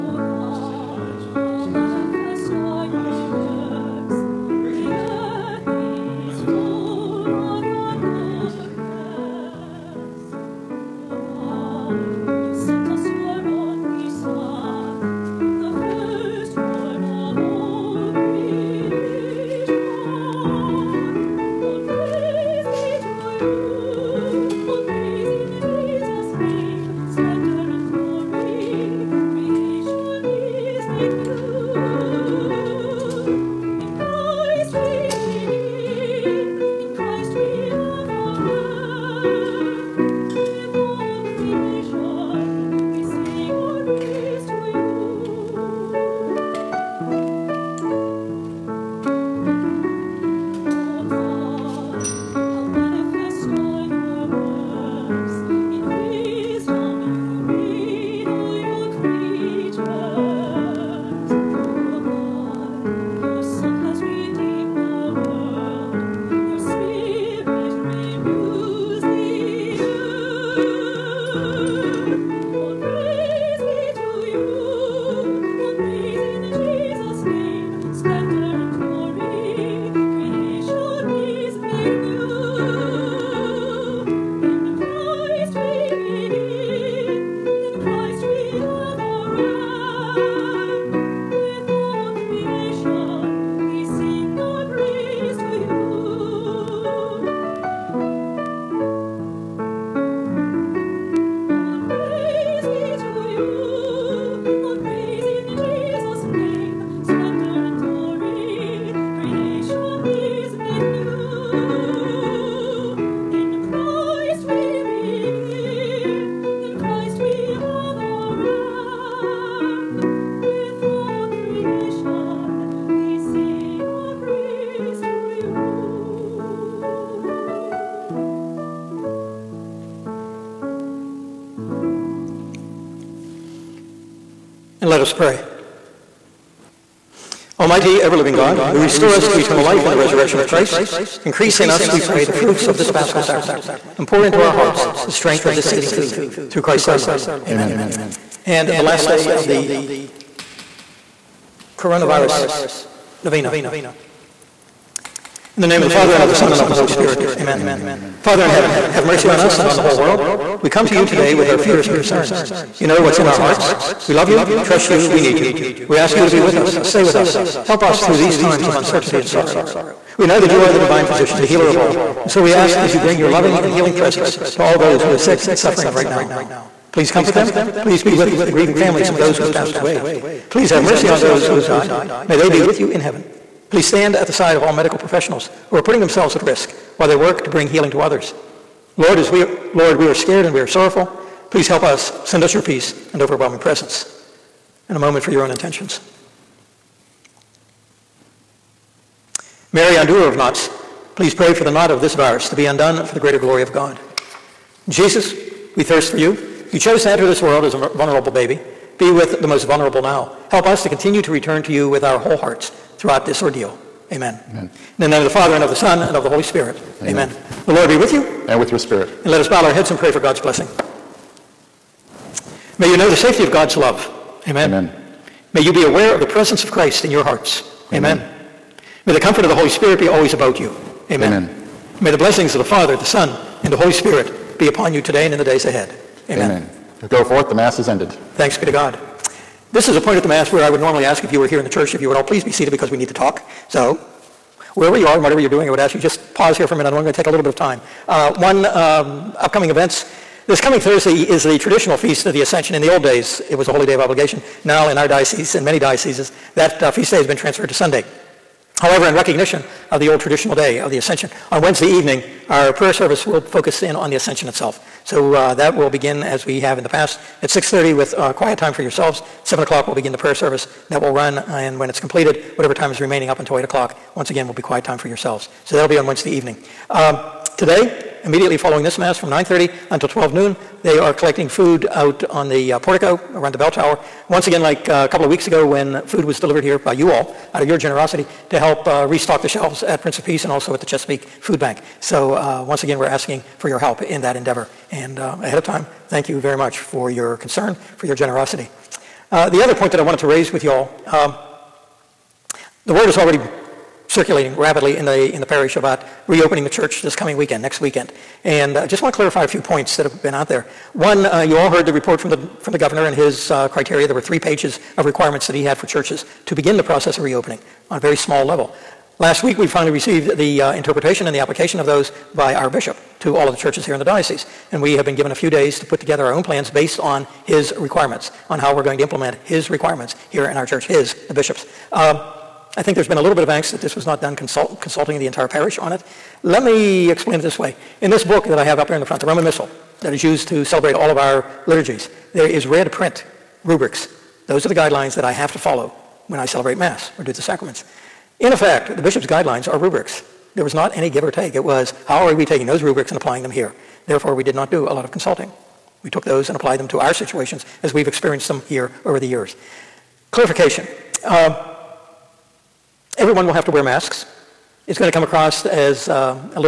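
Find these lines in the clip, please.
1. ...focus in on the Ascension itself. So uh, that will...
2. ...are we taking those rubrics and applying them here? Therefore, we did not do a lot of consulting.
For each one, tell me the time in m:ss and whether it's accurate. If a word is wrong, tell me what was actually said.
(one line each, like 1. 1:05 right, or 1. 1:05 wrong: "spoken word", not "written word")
1. 4:23 right
2. 5:52 right.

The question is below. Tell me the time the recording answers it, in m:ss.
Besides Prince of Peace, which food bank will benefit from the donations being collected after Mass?
4:50.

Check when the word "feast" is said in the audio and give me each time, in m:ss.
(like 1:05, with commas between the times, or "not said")
4:11, 4:16.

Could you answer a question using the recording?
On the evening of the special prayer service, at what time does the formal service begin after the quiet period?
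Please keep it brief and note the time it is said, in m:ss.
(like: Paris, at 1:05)
7 o'clock, at 4:29.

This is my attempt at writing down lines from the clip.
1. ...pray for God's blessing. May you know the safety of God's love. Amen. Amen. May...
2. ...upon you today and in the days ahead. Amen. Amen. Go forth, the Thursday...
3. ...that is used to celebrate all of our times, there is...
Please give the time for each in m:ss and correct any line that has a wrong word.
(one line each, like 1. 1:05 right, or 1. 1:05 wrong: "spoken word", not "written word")
1. 3:39 right
2. 3:54 wrong: "Mass", not "Thursday"
3. 5:40 wrong: "liturgies", not "times".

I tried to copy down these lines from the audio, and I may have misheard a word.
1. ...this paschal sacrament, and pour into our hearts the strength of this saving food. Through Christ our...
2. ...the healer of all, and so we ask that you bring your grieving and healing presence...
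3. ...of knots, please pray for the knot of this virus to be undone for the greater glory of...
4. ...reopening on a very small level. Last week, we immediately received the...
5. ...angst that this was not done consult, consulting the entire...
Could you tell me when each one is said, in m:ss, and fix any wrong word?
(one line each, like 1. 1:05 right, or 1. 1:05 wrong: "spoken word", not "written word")
1. 2:22 right
2. 2:51 wrong: "loving", not "grieving"
3. 3:20 right
4. 5:17 wrong: "finally", not "immediately"
5. 5:33 right.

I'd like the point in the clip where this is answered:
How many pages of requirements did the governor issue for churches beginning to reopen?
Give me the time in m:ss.
5:14.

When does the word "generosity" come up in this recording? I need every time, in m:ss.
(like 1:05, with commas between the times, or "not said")
4:47, 4:58.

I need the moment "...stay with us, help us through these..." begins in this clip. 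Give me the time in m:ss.
2:46.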